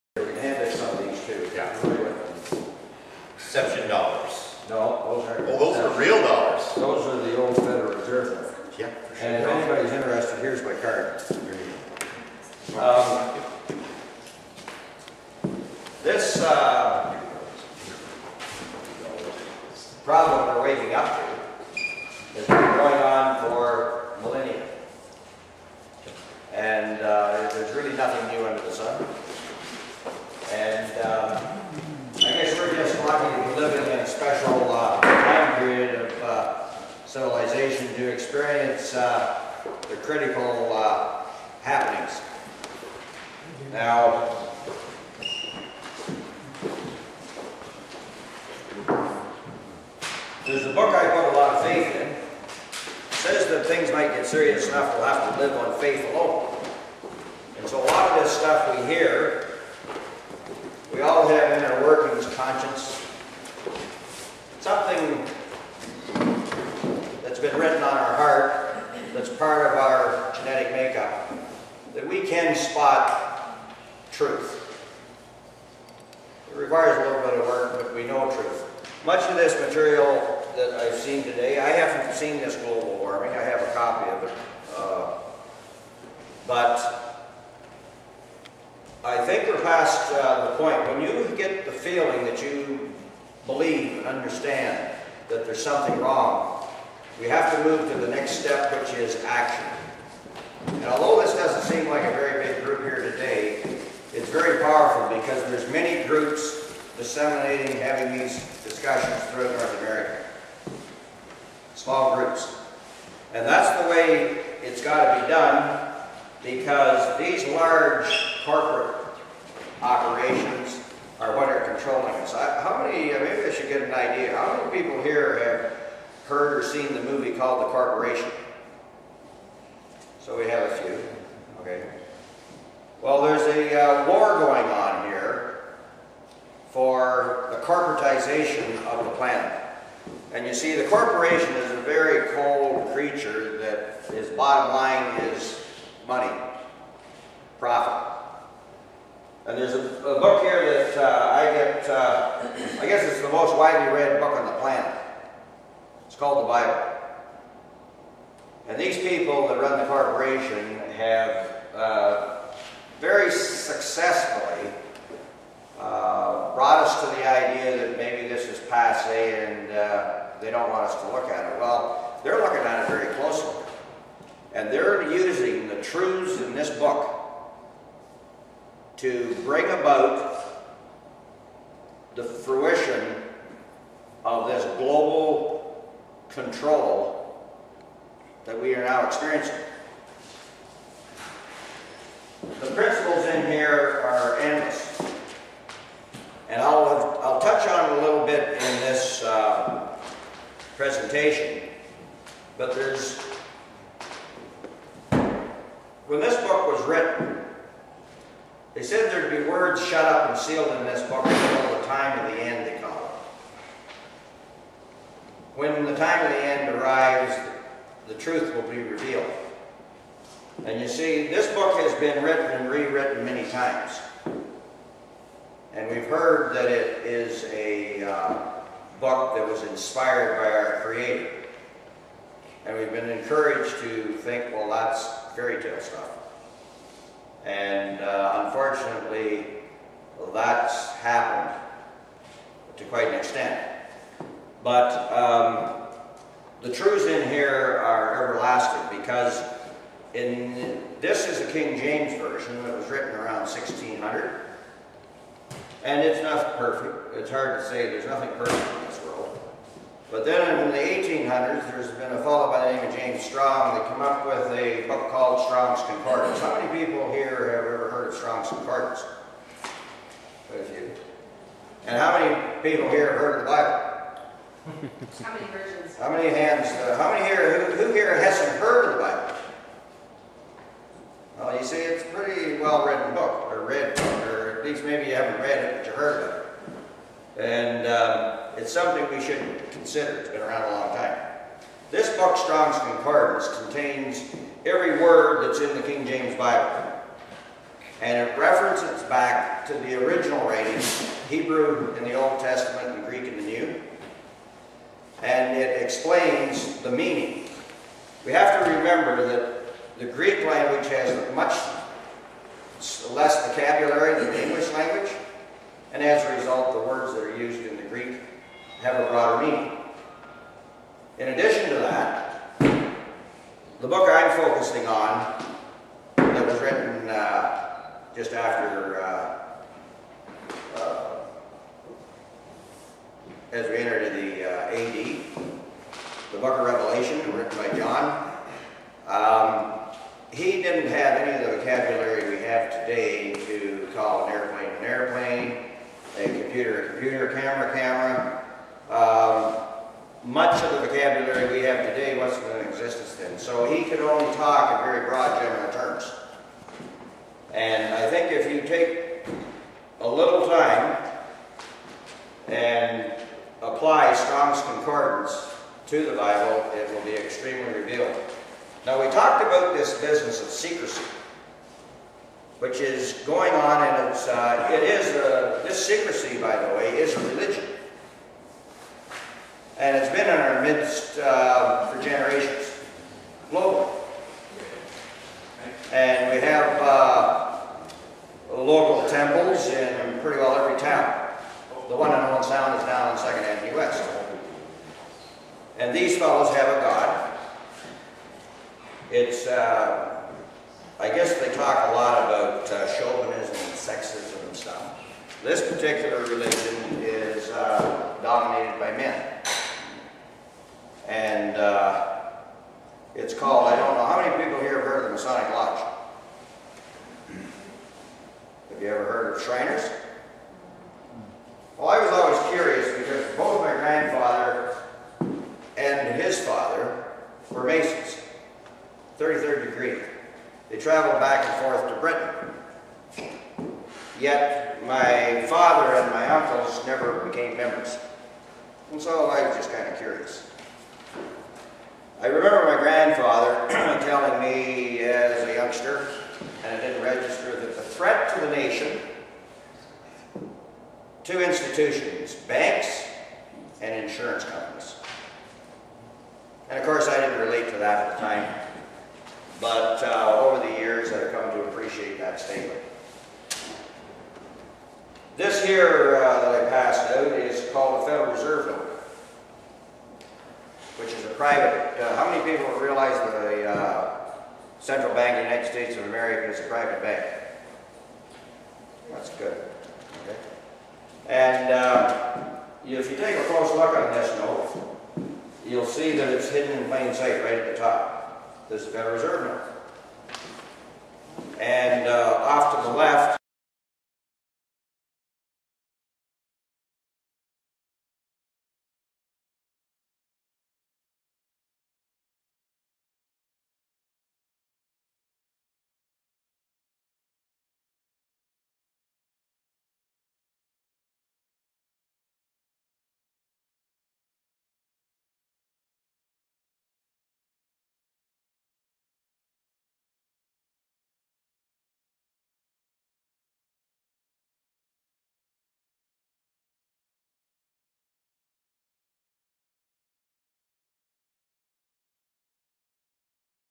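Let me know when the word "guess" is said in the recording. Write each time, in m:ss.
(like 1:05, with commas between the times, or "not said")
2:32, 6:41.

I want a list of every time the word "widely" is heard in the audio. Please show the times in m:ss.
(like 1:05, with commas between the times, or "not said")
2:33.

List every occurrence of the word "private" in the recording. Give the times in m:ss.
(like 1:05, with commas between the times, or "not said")
7:51, 7:56.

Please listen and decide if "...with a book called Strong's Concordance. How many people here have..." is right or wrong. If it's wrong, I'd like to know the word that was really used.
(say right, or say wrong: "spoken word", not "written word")
right.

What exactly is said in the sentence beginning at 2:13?
Well, there's a uh, war going on here for the corporatization of the planet.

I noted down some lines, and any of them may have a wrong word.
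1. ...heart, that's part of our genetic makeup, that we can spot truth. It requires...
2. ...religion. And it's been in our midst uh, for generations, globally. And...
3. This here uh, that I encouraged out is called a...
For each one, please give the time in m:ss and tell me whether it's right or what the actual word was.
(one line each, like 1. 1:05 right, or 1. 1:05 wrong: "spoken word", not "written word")
1. 1:08 right
2. 6:17 right
3. 7:45 wrong: "passed", not "encouraged".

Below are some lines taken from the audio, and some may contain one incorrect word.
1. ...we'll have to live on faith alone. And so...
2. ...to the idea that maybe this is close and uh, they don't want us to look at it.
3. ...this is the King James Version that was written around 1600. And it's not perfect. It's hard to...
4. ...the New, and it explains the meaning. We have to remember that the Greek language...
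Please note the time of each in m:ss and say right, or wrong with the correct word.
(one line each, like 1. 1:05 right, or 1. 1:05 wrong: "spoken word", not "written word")
1. 0:54 right
2. 2:46 wrong: "passe", not "close"
3. 4:10 right
4. 5:03 right.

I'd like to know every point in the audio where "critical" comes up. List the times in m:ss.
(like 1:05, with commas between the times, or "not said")
0:39.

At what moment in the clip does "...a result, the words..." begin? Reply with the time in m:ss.
5:16.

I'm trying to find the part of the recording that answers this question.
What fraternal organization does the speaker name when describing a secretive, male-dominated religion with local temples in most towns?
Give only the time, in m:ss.
6:55.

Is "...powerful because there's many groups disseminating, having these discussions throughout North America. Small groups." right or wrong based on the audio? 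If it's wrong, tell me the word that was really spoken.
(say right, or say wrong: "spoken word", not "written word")
right.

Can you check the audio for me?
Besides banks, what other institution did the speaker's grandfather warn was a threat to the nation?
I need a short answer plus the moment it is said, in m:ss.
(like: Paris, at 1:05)
insurance companies, at 7:34.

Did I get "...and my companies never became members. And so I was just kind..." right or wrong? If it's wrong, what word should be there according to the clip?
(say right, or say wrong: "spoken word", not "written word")
wrong: "uncles", not "companies".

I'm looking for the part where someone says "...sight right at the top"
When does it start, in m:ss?
8:07.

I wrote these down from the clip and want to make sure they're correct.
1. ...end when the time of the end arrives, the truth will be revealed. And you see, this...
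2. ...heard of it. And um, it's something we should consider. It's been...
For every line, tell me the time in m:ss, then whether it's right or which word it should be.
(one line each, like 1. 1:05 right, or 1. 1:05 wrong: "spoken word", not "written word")
1. 3:32 right
2. 4:45 right.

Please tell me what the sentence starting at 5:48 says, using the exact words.
Um, much of the vocabulary we have today wasn't in existence then.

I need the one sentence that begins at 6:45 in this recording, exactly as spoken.
This particular religion is uh, dominated by men.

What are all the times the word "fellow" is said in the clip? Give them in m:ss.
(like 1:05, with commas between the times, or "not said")
4:22, 6:36.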